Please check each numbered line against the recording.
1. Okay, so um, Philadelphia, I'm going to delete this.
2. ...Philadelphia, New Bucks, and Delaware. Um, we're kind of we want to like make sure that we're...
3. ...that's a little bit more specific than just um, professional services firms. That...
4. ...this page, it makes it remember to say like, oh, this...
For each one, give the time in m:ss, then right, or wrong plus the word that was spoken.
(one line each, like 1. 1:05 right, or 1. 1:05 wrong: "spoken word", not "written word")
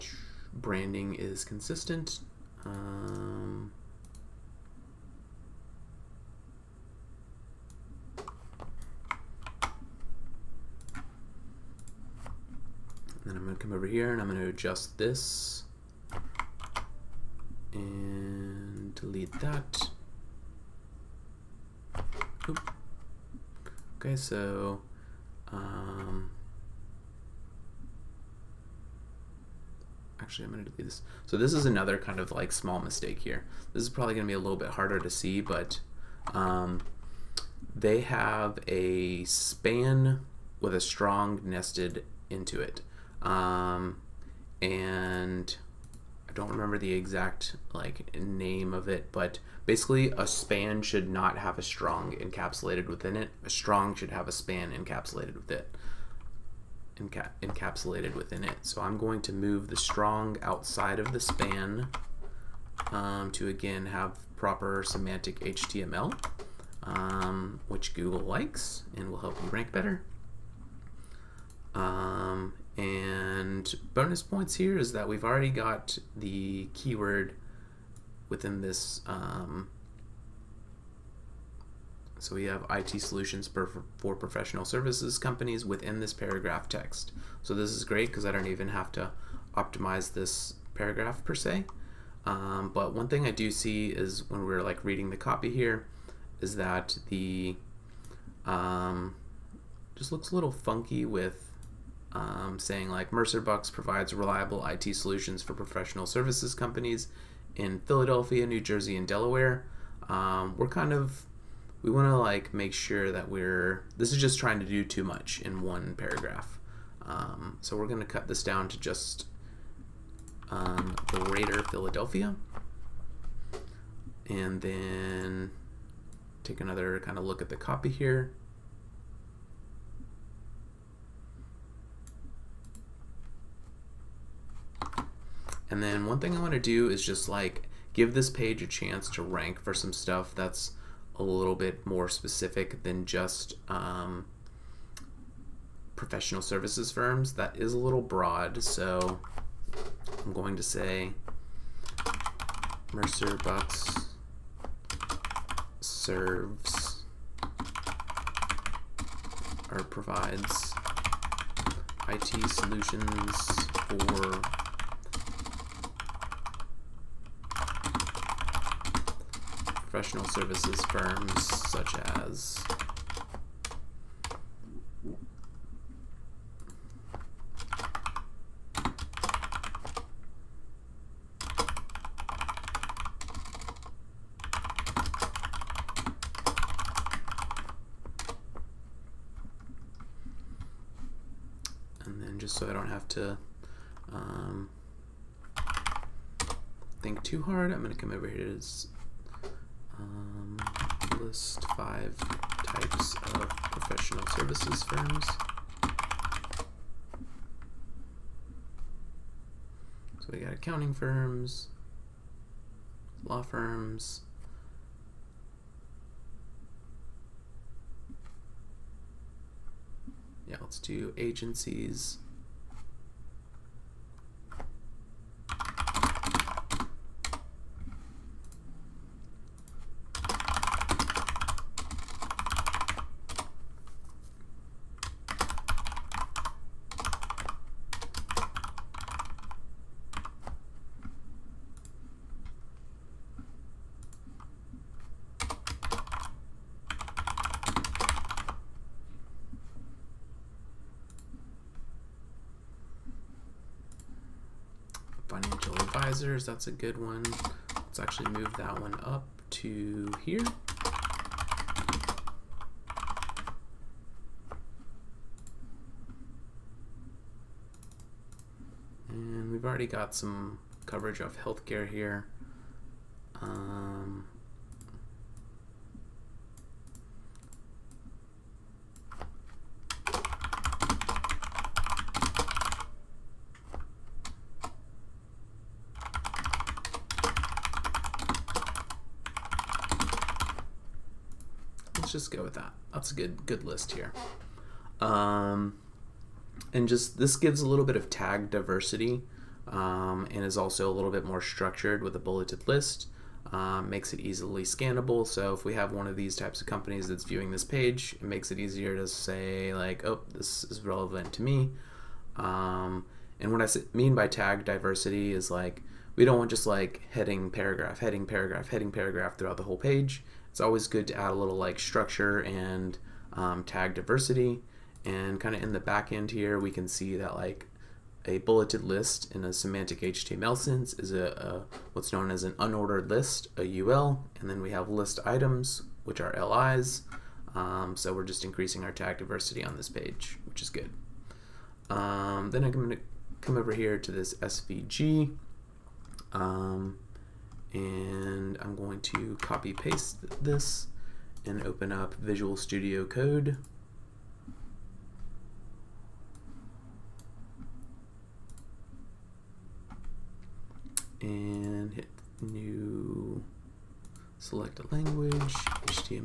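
1. 0:23 wrong: "Actually", not "Philadelphia"
2. 1:47 wrong: "Jersey", not "Bucks"
3. 2:20 right
4. 5:07 wrong: "easier", not "remember".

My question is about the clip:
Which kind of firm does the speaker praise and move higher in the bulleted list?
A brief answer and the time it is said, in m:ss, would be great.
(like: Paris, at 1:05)
agencies, at 3:41.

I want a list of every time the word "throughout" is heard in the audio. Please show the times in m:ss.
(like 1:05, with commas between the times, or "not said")
5:19.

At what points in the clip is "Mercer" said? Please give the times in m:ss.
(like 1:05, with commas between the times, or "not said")
1:43, 2:32.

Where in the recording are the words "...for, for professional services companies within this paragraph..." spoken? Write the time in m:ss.
1:23.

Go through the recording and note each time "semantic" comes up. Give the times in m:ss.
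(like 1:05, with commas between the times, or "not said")
1:04, 5:29.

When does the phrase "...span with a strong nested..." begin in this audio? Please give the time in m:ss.
0:39.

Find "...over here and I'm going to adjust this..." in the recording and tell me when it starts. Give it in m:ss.
0:13.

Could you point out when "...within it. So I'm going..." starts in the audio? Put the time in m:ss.
0:58.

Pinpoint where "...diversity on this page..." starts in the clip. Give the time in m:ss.
5:39.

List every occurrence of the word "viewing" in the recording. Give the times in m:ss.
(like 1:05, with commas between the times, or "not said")
5:07.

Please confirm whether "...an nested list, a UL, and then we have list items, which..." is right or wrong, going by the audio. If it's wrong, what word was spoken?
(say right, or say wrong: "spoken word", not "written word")
wrong: "unordered", not "nested".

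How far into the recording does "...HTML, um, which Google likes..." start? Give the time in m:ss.
1:05.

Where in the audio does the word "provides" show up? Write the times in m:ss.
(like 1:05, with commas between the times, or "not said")
1:43, 2:39.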